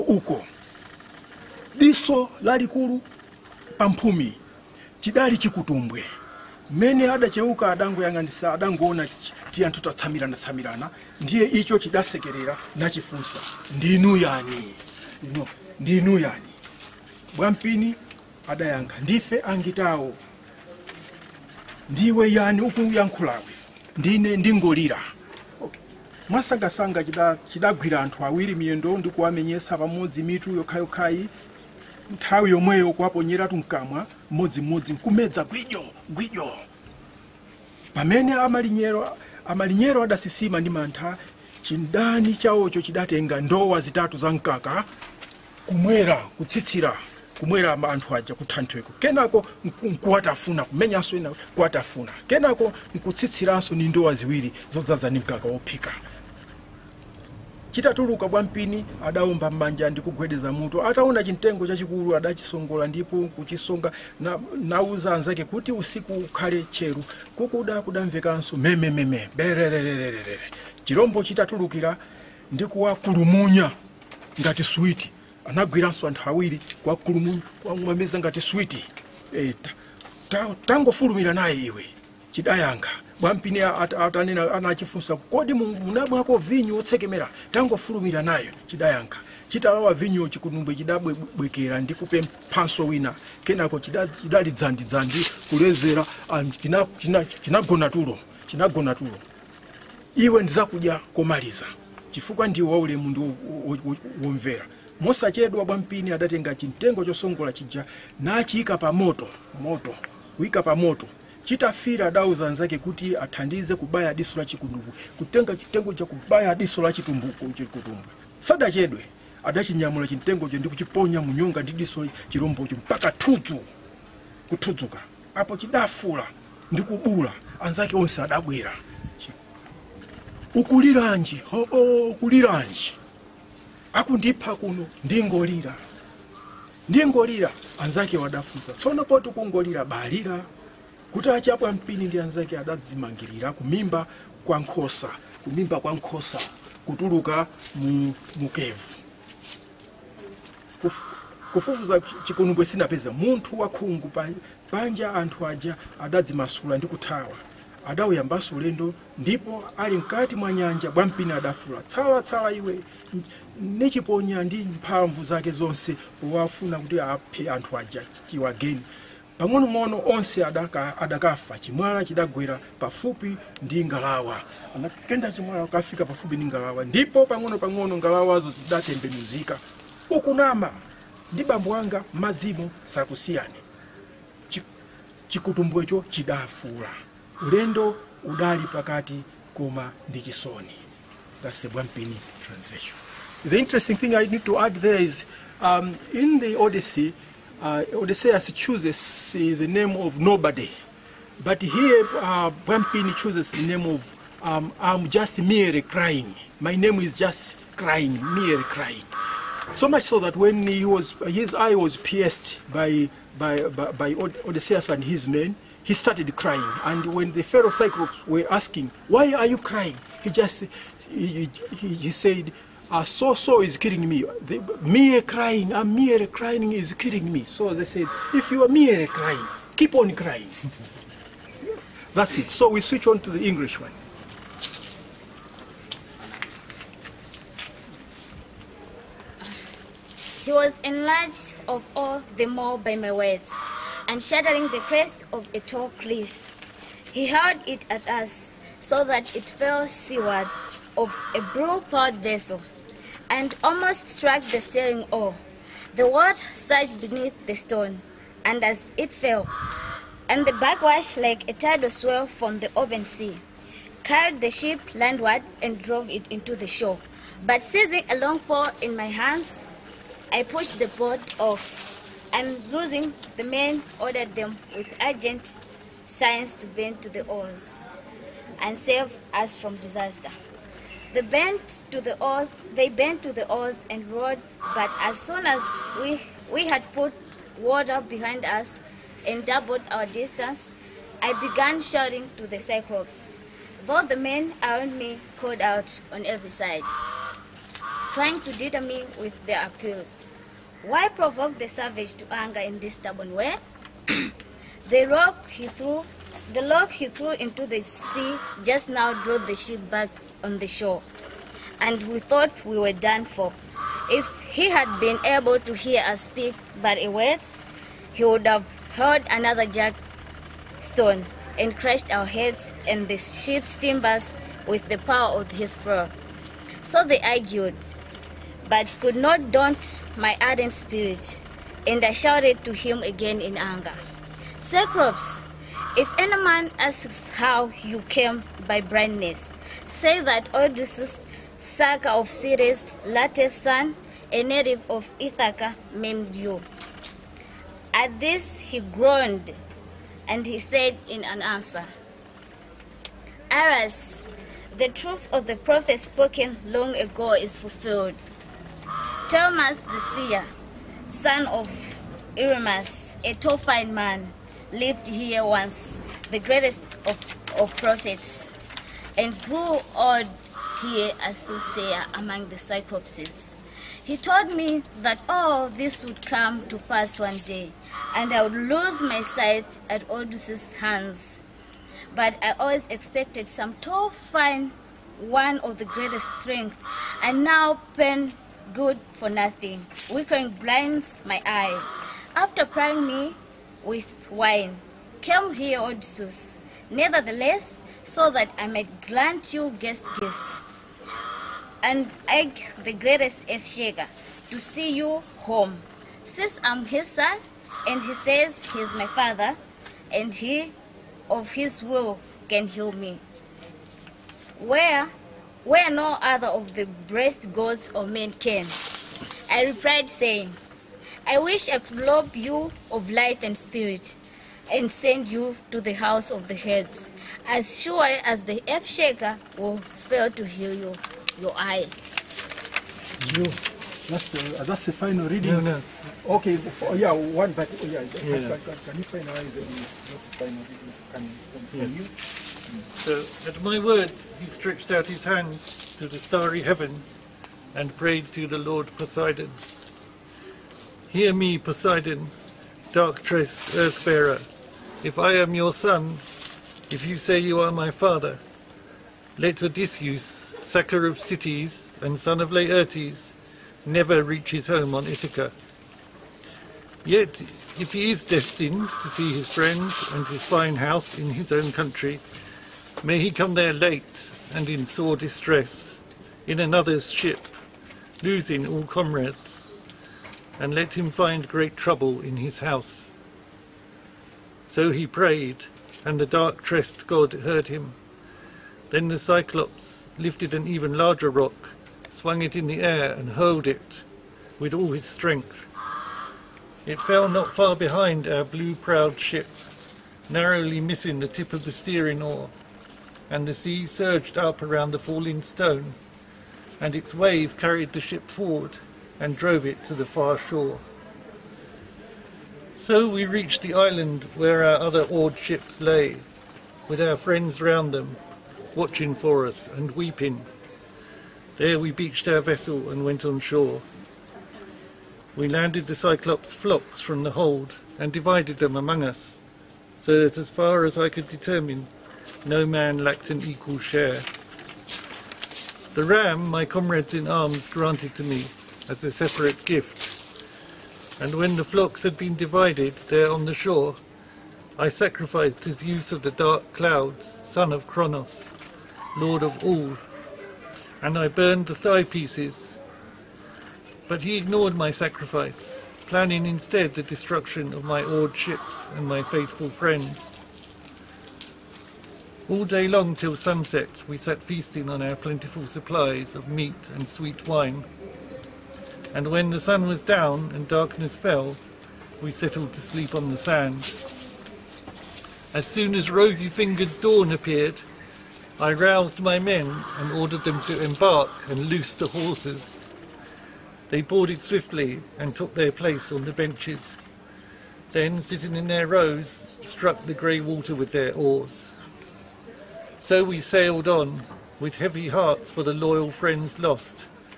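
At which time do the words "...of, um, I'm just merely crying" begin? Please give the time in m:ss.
3:23.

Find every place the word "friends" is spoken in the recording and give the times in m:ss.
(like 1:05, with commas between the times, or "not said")
7:49, 8:37, 9:19, 9:56.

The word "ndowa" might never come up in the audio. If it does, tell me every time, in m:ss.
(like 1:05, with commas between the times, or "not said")
0:43, 0:53.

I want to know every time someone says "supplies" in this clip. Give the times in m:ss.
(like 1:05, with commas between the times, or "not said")
9:25.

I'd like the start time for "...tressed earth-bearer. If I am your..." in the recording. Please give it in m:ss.
7:33.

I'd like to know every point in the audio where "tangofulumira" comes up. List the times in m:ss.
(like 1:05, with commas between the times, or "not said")
1:20, 1:27.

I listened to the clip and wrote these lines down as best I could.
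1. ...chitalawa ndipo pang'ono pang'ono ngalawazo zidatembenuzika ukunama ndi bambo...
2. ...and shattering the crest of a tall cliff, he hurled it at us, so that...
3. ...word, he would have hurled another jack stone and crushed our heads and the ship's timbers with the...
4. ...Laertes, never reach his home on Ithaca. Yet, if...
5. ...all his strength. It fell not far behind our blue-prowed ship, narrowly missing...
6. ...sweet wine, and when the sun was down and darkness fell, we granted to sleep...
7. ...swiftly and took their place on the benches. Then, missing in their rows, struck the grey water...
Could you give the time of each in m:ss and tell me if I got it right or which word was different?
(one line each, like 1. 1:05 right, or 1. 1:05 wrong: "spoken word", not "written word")
1. 2:56 wrong: "ngalawa", not "chitalawa"
2. 4:04 right
3. 5:17 right
4. 7:42 right
5. 8:14 right
6. 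9:27 wrong: "settled", not "granted"
7. 9:44 wrong: "sitting", not "missing".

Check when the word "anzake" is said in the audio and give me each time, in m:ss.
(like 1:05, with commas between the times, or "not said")
1:05, 2:07, 2:17, 2:22.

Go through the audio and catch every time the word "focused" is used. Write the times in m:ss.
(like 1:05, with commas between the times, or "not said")
not said.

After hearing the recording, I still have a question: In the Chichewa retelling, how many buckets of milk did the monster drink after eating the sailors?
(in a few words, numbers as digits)
3.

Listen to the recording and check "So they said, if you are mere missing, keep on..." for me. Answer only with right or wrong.
wrong.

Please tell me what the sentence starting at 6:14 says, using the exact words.
He told me that all this would come to pass one day, and I would lose my sight at Odysseus' hands.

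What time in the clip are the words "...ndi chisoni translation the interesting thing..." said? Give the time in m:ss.
3:10.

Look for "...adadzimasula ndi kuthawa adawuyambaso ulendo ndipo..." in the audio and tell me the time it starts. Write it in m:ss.
2:35.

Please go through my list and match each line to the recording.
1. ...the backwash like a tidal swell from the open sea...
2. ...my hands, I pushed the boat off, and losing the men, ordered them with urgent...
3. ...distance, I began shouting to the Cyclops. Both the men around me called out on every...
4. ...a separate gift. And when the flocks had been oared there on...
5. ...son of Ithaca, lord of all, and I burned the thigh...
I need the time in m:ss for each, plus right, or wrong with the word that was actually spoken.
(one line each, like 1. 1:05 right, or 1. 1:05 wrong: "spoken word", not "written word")
1. 4:20 right
2. 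4:28 right
3. 4:50 right
4. 8:59 wrong: "divided", not "oared"
5. 9:07 wrong: "Kronos", not "Ithaca".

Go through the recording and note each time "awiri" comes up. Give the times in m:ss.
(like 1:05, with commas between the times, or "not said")
0:28, 1:16.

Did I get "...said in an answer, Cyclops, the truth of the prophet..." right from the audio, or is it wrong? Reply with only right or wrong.
wrong.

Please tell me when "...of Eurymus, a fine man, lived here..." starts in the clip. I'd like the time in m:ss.
6:01.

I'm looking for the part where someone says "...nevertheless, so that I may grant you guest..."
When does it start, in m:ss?
6:36.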